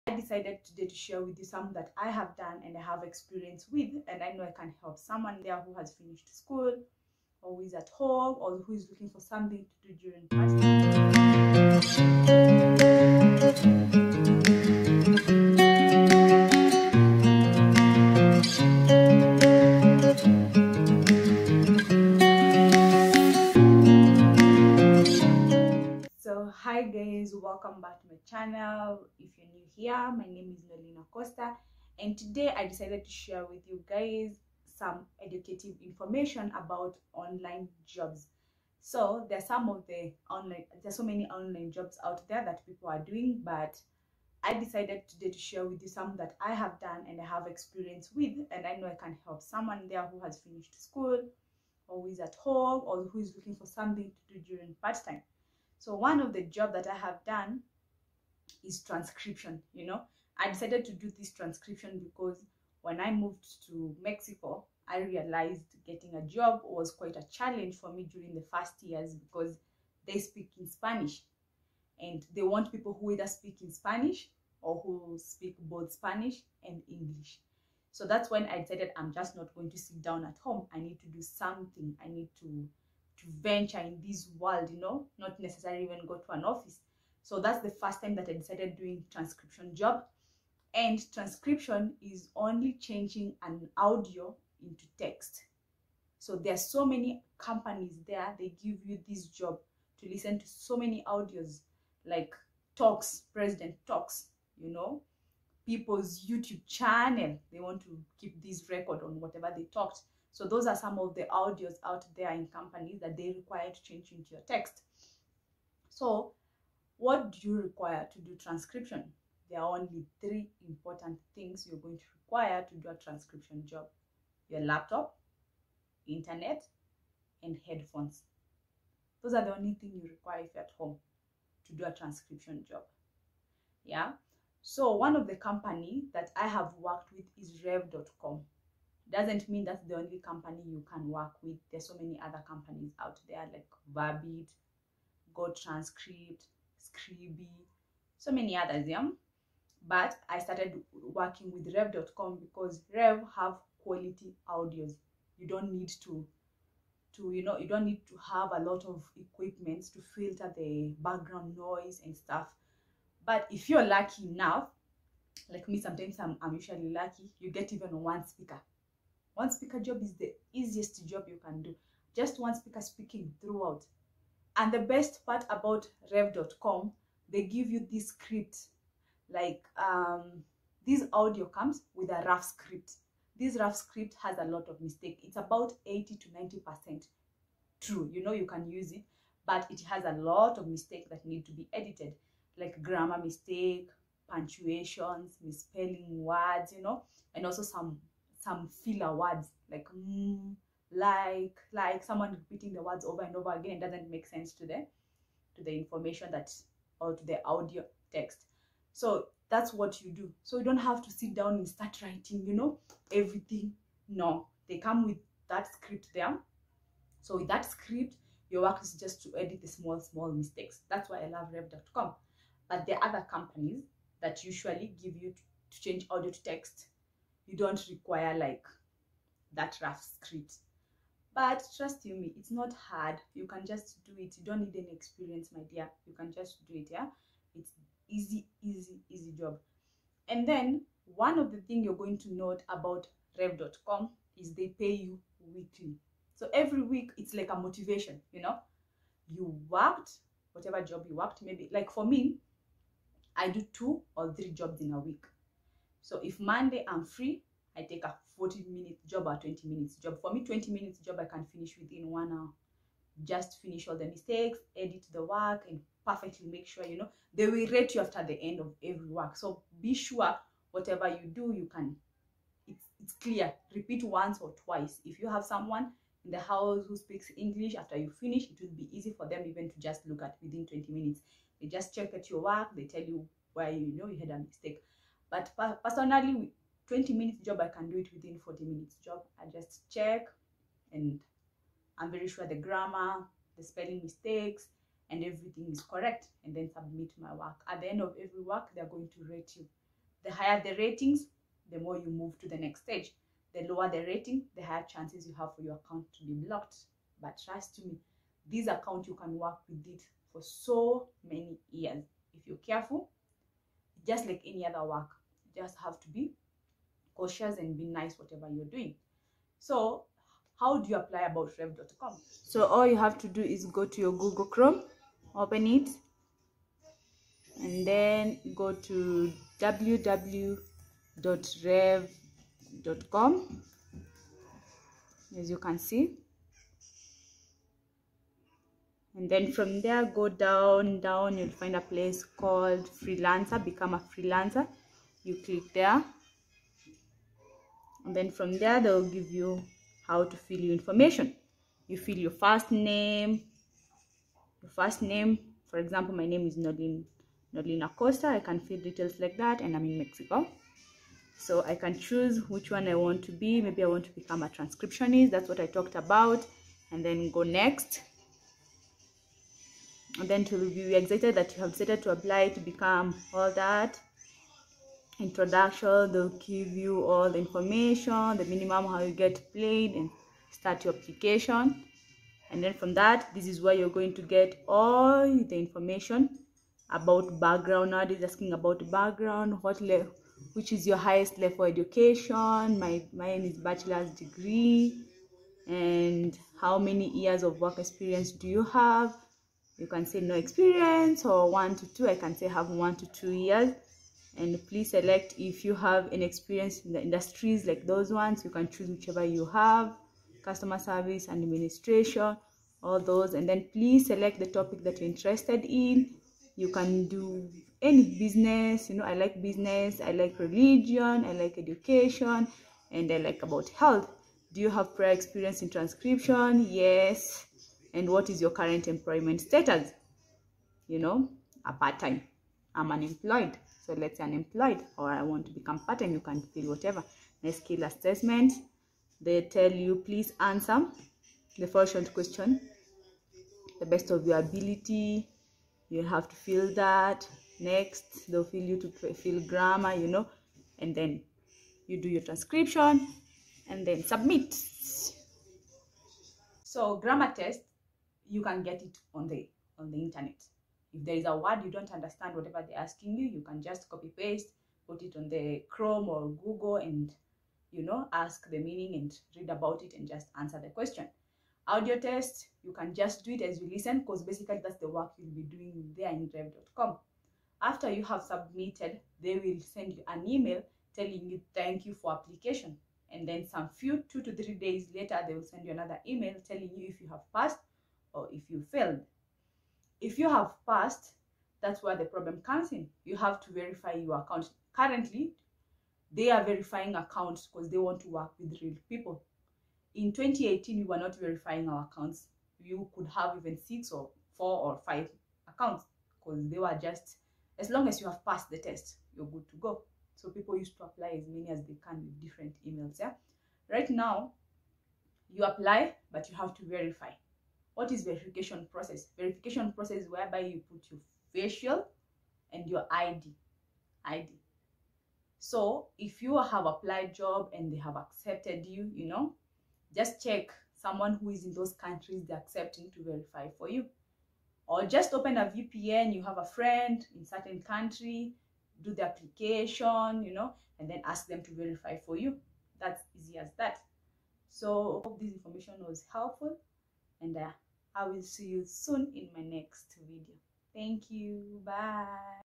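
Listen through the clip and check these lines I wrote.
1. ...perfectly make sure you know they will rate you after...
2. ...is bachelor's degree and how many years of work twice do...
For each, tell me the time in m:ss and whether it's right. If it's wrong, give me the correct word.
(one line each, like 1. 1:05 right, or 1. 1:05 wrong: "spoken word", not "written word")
1. 4:26 right
2. 6:33 wrong: "experience", not "twice".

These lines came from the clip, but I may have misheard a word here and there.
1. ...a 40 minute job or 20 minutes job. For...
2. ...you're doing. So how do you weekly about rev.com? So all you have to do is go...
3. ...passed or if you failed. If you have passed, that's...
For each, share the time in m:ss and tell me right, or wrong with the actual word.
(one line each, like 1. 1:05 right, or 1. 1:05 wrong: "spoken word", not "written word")
1. 4:18 right
2. 5:18 wrong: "apply", not "weekly"
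3. 8:07 right.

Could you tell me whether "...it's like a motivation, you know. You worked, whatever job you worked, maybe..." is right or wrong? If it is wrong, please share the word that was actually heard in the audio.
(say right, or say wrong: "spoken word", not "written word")
right.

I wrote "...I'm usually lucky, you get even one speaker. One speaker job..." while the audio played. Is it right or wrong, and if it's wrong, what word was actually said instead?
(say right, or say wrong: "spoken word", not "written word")
right.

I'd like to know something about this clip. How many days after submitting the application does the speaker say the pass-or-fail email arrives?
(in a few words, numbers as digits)
2 to 3 days.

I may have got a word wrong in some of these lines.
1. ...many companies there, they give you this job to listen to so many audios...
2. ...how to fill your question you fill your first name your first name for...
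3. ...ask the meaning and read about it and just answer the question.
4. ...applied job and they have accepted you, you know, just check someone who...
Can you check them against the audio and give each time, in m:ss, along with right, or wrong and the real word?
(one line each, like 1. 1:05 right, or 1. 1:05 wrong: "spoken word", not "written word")
1. 1:36 right
2. 5:50 wrong: "information", not "question"
3. 7:48 right
4. 8:46 right.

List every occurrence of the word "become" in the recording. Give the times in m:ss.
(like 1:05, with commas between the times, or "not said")
5:43, 6:04, 6:12, 7:15.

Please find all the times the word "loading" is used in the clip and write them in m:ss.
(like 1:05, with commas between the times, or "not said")
not said.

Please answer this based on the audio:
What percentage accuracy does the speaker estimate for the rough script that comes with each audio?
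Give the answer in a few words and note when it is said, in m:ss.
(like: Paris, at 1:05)
80 to 90%, at 3:05.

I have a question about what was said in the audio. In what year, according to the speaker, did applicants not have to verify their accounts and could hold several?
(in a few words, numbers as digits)
2018.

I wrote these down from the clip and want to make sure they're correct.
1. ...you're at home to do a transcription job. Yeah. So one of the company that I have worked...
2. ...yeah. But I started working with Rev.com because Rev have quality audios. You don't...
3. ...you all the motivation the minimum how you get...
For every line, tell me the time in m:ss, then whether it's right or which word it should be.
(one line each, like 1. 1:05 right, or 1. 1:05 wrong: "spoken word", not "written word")
1. 2:10 right
2. 2:28 right
3. 6:16 wrong: "information", not "motivation".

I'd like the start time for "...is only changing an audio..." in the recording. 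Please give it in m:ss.
1:32.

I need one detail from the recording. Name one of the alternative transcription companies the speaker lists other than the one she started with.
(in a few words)
Verbit.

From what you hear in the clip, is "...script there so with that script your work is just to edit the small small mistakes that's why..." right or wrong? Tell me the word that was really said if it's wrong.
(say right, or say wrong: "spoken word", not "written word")
right.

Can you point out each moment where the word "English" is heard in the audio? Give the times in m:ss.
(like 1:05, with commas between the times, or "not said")
1:16, 4:37.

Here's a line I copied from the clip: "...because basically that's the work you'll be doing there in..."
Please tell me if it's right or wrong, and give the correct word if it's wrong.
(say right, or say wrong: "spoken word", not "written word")
right.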